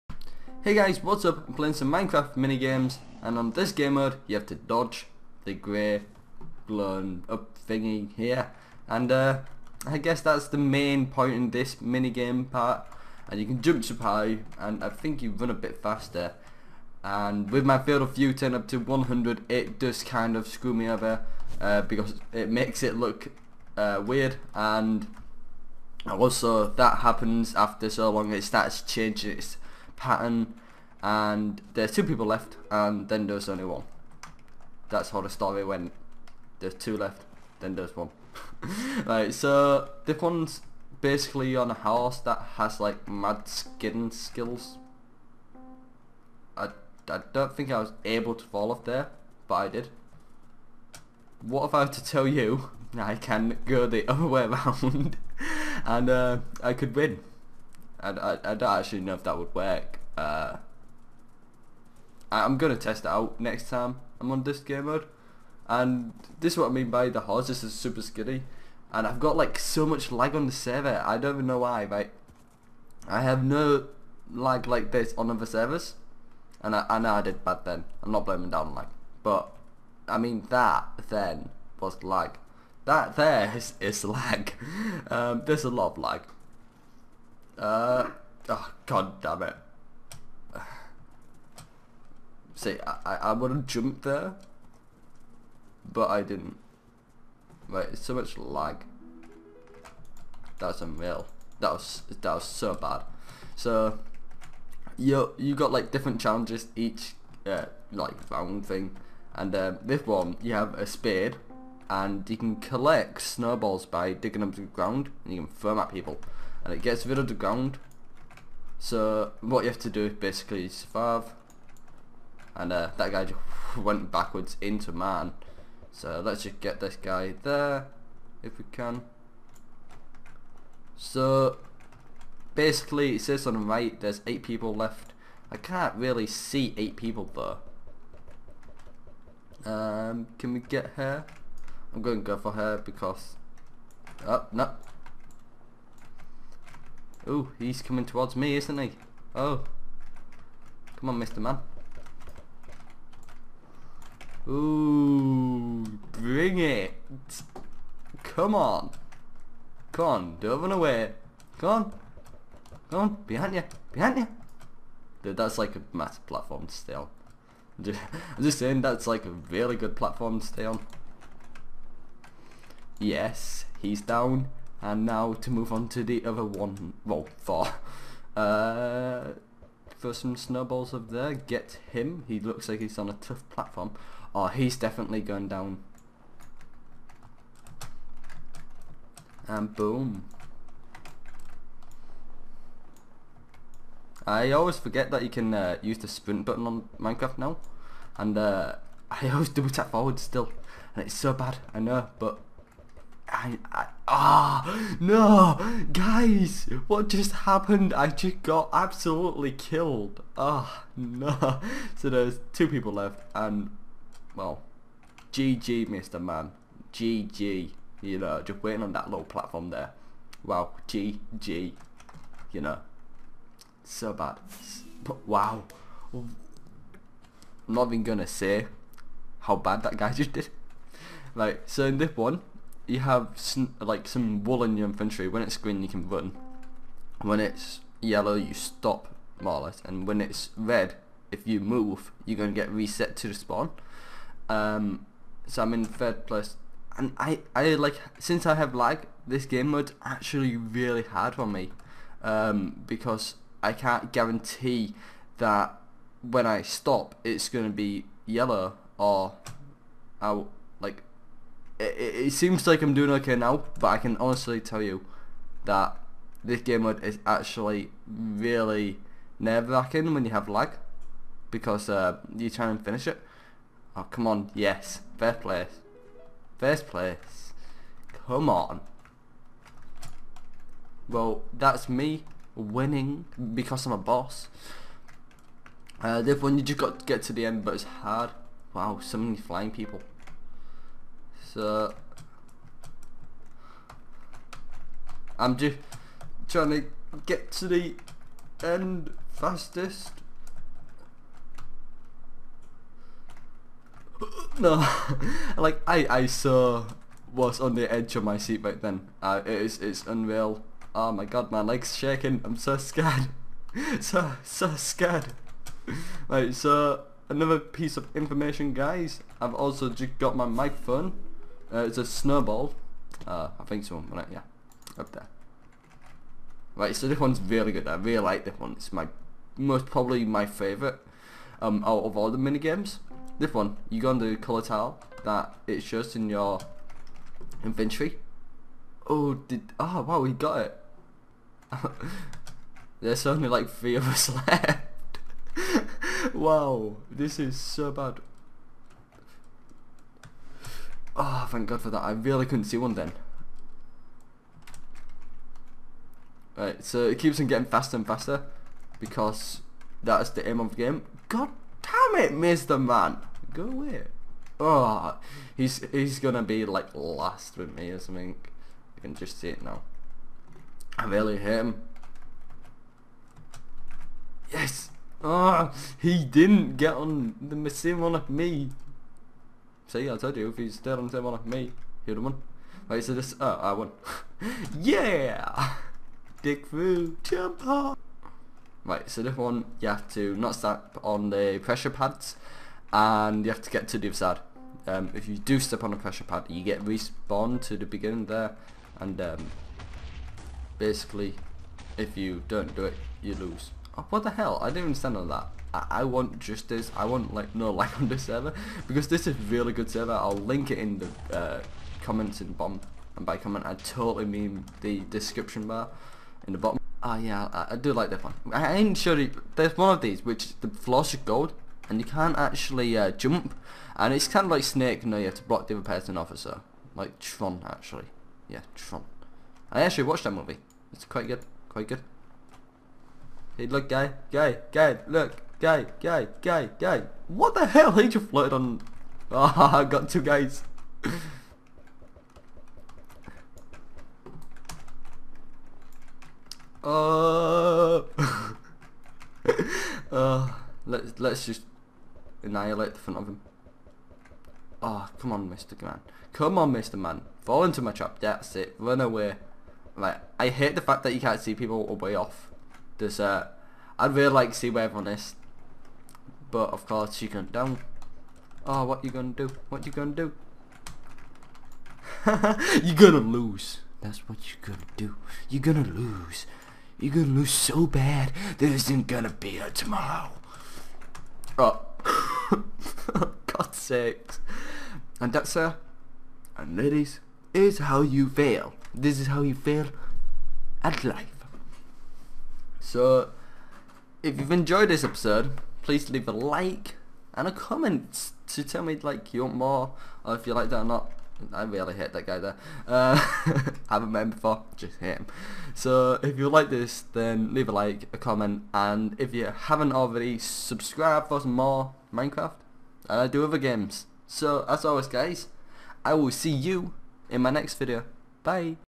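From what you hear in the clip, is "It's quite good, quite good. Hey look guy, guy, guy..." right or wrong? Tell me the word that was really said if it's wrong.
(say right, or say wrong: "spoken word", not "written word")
right.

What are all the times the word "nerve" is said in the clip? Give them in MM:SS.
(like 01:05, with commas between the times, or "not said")
04:29.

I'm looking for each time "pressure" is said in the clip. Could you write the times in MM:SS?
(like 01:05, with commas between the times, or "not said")
06:31, 06:35.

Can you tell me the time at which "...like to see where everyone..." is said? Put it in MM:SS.
07:44.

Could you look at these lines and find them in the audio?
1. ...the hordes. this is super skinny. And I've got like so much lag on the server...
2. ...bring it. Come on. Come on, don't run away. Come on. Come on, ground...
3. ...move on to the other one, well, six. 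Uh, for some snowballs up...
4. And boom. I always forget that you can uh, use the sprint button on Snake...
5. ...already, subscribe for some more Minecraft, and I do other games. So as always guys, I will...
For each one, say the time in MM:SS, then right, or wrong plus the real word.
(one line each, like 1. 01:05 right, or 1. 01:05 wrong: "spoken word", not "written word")
1. 01:07 right
2. 02:36 wrong: "behind", not "ground"
3. 02:55 wrong: "four", not "six"
4. 03:09 wrong: "Minecraft", not "Snake"
5. 08:29 right.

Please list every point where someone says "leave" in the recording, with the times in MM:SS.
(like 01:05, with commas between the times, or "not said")
08:16, 08:27.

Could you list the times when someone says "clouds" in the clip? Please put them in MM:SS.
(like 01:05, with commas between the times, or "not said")
not said.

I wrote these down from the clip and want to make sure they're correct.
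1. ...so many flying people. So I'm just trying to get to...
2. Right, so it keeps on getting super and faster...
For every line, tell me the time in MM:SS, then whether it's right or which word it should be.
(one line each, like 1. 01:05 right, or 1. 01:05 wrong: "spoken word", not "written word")
1. 04:49 right
2. 05:56 wrong: "faster", not "super".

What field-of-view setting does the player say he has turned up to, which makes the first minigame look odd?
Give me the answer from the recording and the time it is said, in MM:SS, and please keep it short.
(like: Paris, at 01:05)
100, at 00:18.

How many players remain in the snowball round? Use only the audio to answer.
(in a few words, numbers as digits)
8.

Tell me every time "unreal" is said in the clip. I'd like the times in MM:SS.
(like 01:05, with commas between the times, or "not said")
01:40, 05:10.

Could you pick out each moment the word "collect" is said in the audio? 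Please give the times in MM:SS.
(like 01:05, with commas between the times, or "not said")
01:52.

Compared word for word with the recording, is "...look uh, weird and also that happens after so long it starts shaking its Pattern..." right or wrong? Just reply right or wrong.
wrong.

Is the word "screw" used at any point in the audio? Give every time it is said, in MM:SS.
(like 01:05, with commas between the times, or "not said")
00:20.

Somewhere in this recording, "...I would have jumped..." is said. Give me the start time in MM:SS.
01:33.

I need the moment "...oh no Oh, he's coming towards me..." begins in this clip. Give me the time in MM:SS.
02:24.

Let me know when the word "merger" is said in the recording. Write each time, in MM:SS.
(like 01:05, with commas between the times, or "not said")
not said.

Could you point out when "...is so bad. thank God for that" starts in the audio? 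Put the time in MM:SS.
05:47.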